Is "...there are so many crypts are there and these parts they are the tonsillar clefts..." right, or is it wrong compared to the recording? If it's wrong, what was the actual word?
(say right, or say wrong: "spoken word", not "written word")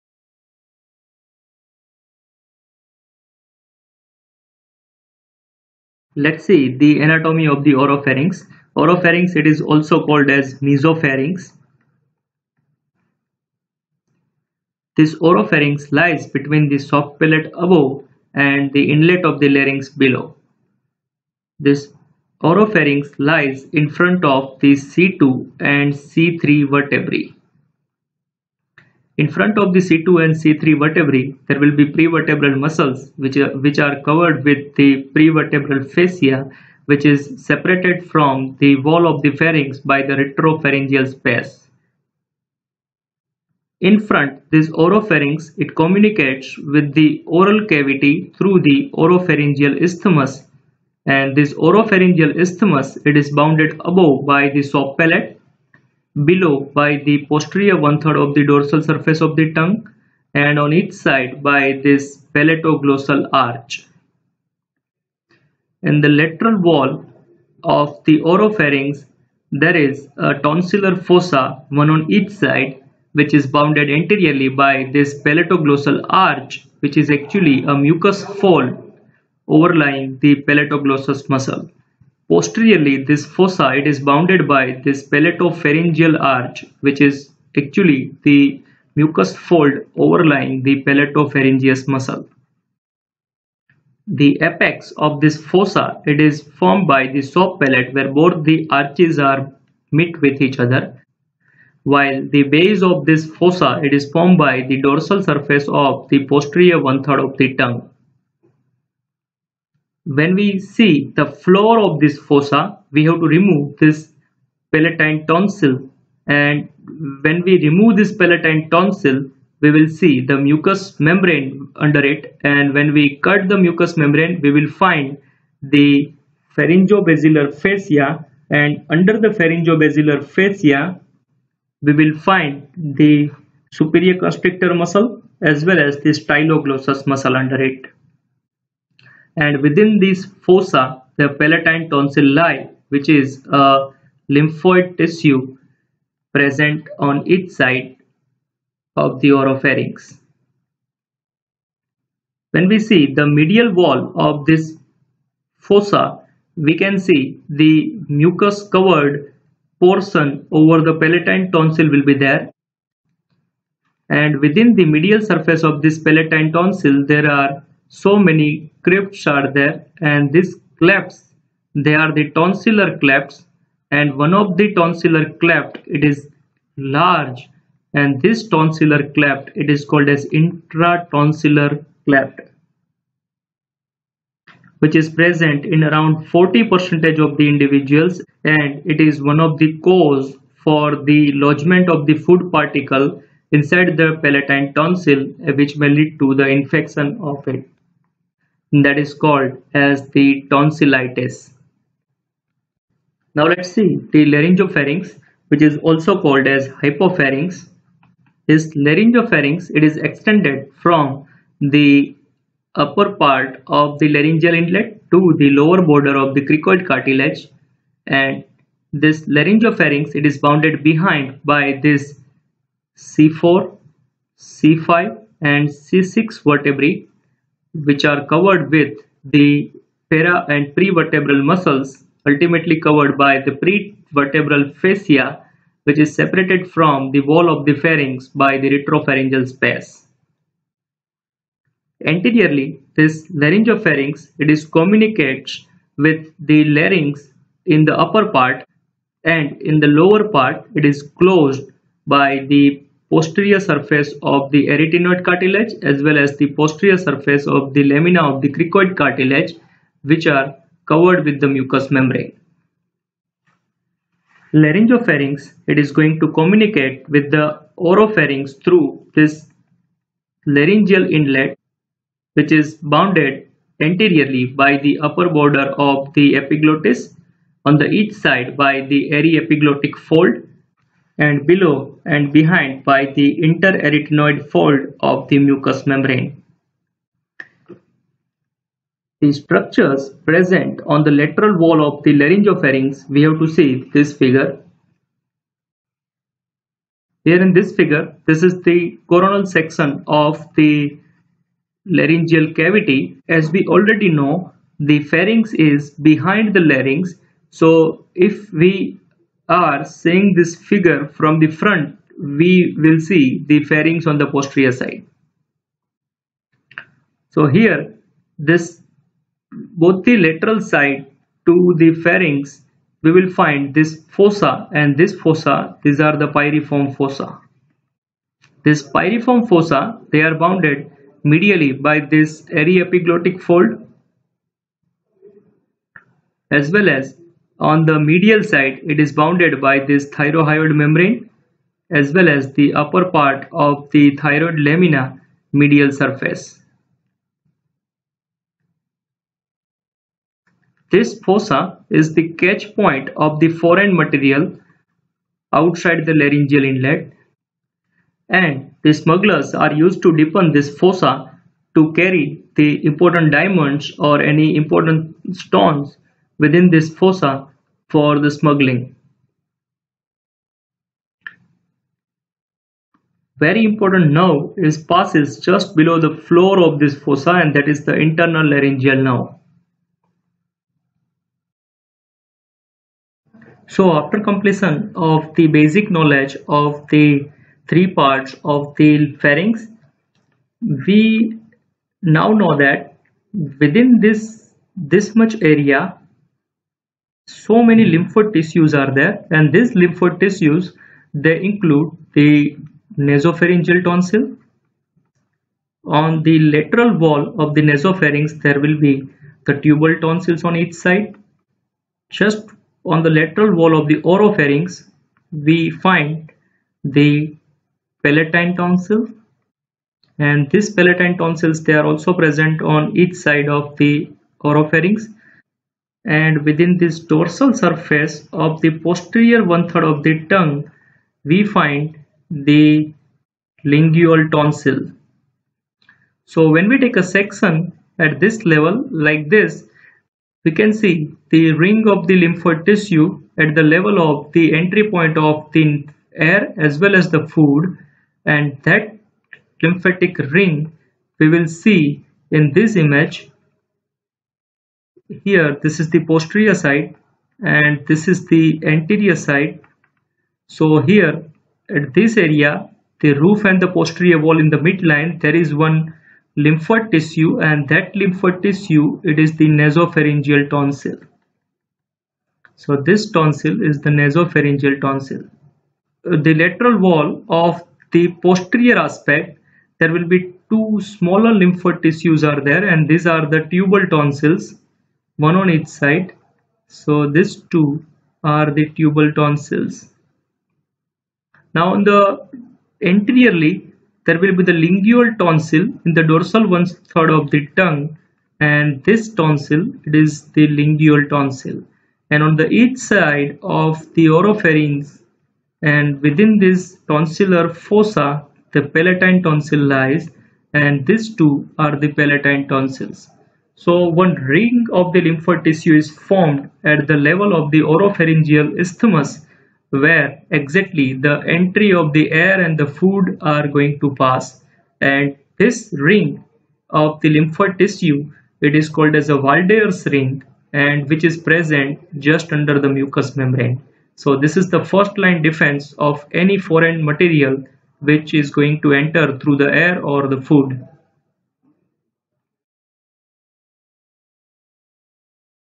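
wrong: "clefts", not "parts".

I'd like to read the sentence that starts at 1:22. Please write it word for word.
Posteriorly, this fossa it is bounded by this palatopharyngeal arch, which is actually the mucous fold overlying the palatopharyngeus muscle.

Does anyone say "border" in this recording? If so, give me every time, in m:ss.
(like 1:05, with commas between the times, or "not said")
3:35, 4:35.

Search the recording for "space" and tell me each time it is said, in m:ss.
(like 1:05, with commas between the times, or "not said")
0:41, 3:59.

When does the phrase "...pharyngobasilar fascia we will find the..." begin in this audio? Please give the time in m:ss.
2:09.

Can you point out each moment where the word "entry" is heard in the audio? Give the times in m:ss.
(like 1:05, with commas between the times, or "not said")
7:24, 8:41.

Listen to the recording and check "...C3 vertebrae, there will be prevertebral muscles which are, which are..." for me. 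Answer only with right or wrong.
right.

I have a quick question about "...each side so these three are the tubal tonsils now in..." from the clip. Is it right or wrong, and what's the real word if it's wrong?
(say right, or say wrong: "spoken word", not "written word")
wrong: "two", not "three".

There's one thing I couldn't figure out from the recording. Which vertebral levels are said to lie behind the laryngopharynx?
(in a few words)
C4, C5 and C6.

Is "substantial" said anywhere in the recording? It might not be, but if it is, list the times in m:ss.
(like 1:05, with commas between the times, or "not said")
not said.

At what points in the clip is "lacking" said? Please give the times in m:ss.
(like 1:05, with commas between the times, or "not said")
not said.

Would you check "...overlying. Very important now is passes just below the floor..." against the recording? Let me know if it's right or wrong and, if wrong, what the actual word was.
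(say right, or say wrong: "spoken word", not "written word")
wrong: "smuggling", not "overlying".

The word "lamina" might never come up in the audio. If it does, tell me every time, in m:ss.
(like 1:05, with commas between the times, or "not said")
4:17, 5:44.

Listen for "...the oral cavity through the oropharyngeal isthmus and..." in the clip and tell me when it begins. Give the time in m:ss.
0:46.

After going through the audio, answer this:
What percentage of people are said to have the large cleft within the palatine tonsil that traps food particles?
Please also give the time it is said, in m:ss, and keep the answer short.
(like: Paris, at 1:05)
40, at 3:06.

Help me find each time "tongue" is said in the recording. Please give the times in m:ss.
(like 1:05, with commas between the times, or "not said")
0:59, 1:47, 7:10, 8:17.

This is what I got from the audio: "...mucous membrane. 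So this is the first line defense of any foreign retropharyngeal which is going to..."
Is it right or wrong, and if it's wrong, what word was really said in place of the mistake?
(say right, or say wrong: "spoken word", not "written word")
wrong: "material", not "retropharyngeal".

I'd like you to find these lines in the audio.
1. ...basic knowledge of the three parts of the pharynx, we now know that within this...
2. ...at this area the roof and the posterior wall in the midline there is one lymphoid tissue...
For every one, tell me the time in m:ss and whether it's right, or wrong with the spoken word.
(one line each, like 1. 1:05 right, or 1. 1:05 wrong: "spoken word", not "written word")
1. 6:25 right
2. 7:41 right.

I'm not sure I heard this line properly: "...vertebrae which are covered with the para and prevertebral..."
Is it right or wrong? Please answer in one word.
right.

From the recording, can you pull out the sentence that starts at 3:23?
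Now let's see the laryngopharynx which is also called as hypopharynx.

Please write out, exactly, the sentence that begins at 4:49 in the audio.
The structures present on the lateral wall of the laryngopharynx, we have to see this figure.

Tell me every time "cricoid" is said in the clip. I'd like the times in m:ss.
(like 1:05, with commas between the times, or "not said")
3:36, 4:18.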